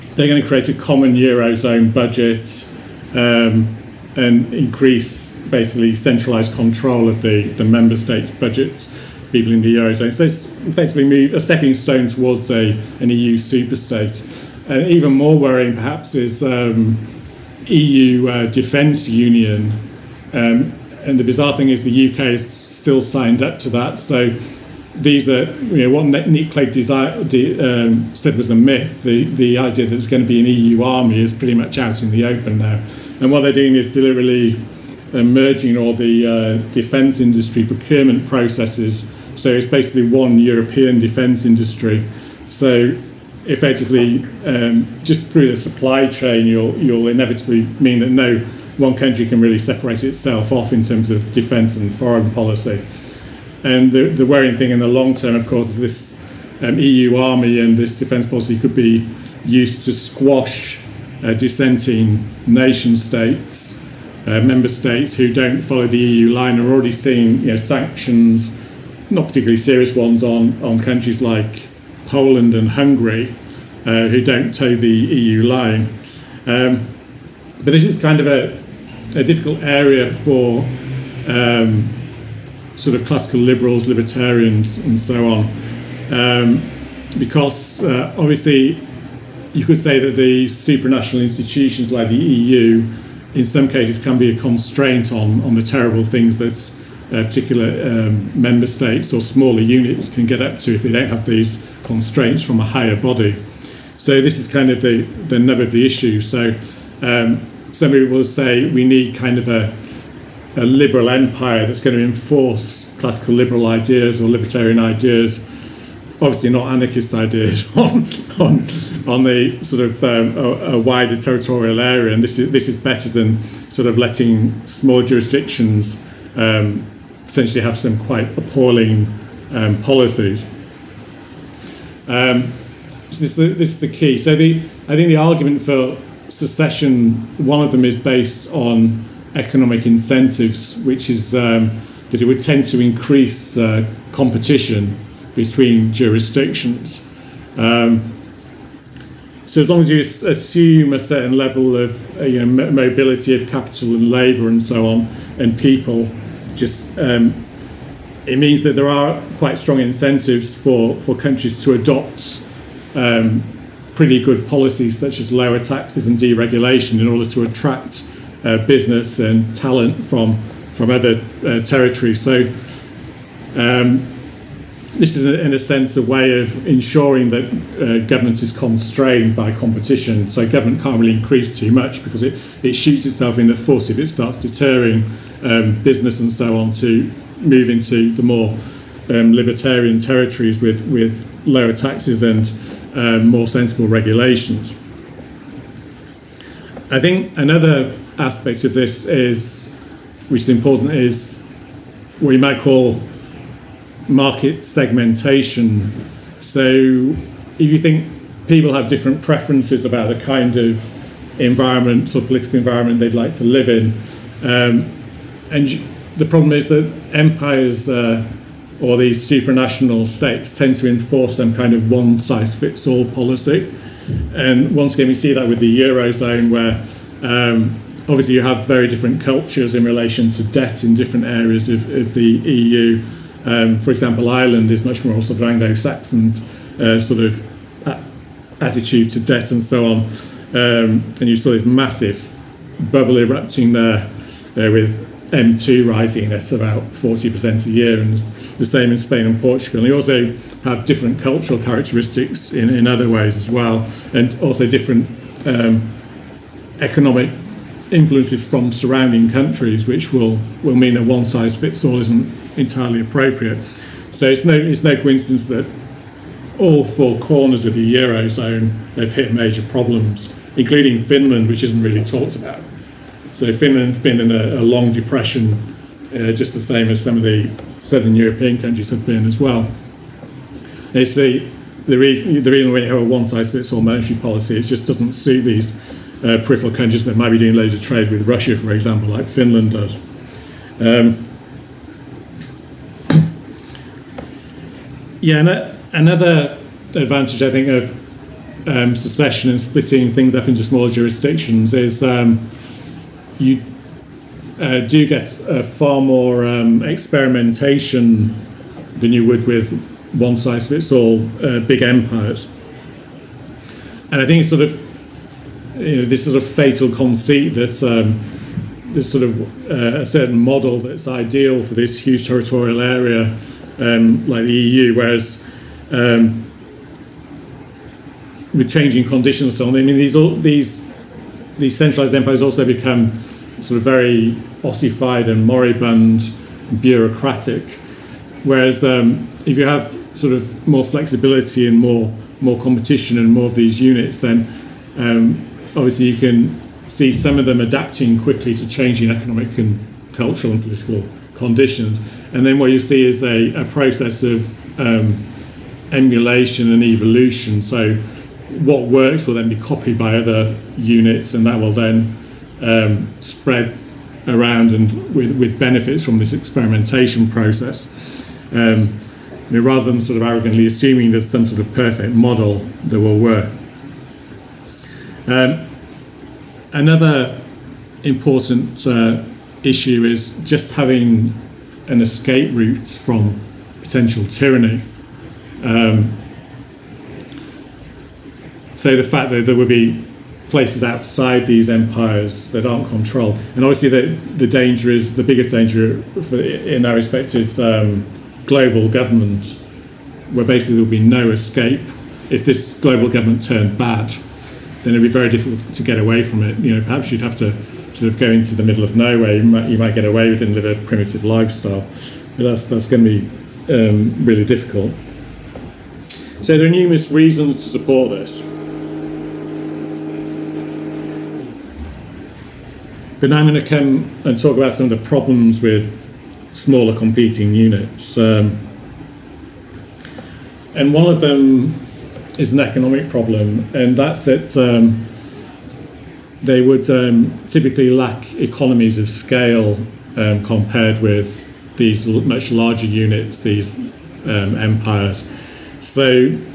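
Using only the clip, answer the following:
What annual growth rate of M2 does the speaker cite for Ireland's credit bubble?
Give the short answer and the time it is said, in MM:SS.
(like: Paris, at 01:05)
40%, at 04:06.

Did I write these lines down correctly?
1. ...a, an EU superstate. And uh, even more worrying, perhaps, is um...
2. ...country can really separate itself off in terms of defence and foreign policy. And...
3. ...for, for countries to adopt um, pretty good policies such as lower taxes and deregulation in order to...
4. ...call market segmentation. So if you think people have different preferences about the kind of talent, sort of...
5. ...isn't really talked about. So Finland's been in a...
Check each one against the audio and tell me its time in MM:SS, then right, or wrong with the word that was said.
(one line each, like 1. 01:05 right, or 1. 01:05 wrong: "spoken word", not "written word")
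1. 00:12 right
2. 00:48 right
3. 02:40 right
4. 03:22 wrong: "environment", not "talent"
5. 04:31 right.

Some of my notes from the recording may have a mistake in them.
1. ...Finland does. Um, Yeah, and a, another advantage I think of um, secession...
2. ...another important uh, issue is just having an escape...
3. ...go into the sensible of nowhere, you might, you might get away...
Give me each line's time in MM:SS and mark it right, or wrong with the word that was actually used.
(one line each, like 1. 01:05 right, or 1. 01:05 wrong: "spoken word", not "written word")
1. 04:49 right
2. 06:16 right
3. 06:48 wrong: "middle", not "sensible".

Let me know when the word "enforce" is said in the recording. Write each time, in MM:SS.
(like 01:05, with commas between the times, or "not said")
01:52, 03:40.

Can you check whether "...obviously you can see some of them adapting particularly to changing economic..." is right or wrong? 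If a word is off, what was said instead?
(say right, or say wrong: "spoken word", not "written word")
wrong: "quickly", not "particularly".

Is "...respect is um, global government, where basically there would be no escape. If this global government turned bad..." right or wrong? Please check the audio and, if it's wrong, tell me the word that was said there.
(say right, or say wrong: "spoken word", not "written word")
right.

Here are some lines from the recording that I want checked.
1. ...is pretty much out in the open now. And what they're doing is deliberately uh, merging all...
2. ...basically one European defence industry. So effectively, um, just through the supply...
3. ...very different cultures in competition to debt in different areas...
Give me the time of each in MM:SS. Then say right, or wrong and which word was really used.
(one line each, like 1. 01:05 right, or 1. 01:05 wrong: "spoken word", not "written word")
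1. 00:31 right
2. 00:39 right
3. 03:48 wrong: "relation", not "competition".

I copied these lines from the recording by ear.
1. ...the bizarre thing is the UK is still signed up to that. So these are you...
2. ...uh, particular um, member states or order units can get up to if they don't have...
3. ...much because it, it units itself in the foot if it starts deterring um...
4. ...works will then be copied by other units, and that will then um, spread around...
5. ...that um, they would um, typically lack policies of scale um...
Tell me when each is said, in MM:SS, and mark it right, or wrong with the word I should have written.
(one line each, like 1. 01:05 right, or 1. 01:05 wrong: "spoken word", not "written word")
1. 00:21 right
2. 01:37 wrong: "smaller", not "order"
3. 03:01 wrong: "shoots", not "units"
4. 05:58 right
5. 07:14 wrong: "economies", not "policies".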